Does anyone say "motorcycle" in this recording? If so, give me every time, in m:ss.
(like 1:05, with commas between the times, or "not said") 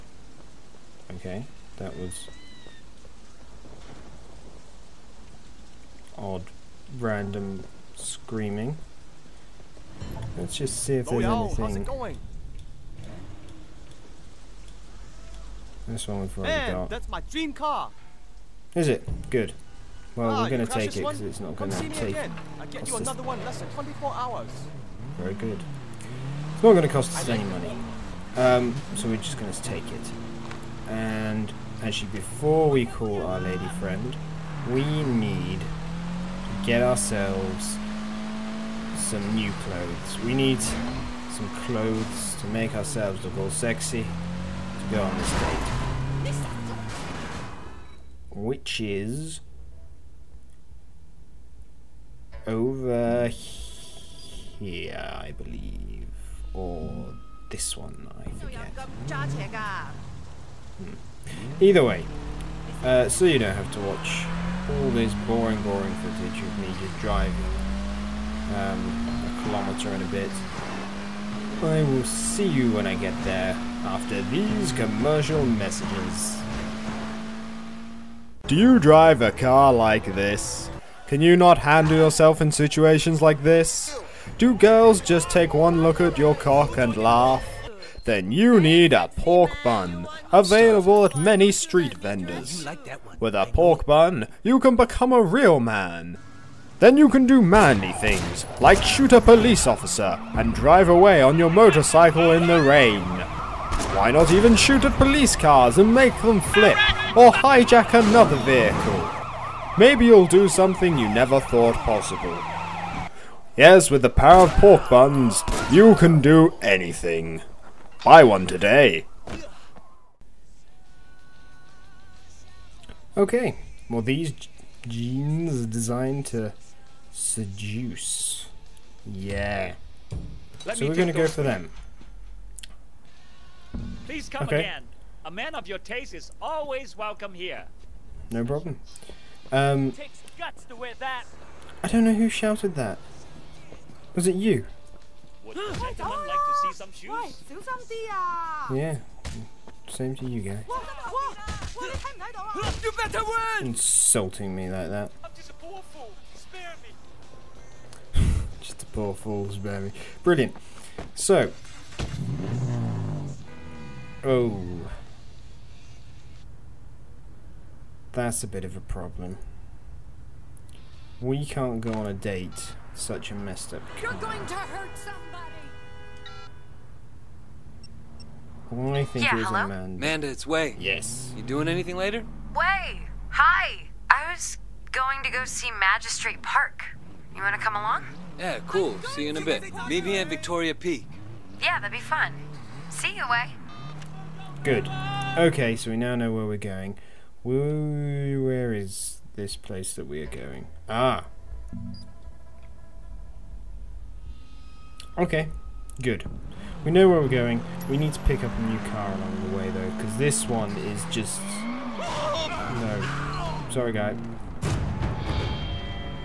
1:41.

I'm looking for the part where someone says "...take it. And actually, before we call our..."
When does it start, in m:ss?
0:29.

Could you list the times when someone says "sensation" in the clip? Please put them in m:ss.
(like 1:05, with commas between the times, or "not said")
not said.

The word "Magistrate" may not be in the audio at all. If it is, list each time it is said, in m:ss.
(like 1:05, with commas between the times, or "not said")
3:05.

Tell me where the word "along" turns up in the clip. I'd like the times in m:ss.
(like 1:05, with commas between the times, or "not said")
3:07, 3:29.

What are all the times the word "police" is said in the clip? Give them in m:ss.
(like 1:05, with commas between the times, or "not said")
1:39, 1:44.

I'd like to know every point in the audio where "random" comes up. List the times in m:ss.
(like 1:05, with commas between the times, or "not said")
0:06.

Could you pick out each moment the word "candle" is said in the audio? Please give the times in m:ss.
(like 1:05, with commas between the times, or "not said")
not said.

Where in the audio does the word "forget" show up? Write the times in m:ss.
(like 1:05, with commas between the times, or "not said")
0:58.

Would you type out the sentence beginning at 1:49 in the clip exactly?
Maybe you'll do something you never thought possible.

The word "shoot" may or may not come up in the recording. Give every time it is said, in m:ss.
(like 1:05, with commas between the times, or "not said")
1:38, 1:44.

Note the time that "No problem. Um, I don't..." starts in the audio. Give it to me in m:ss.
2:18.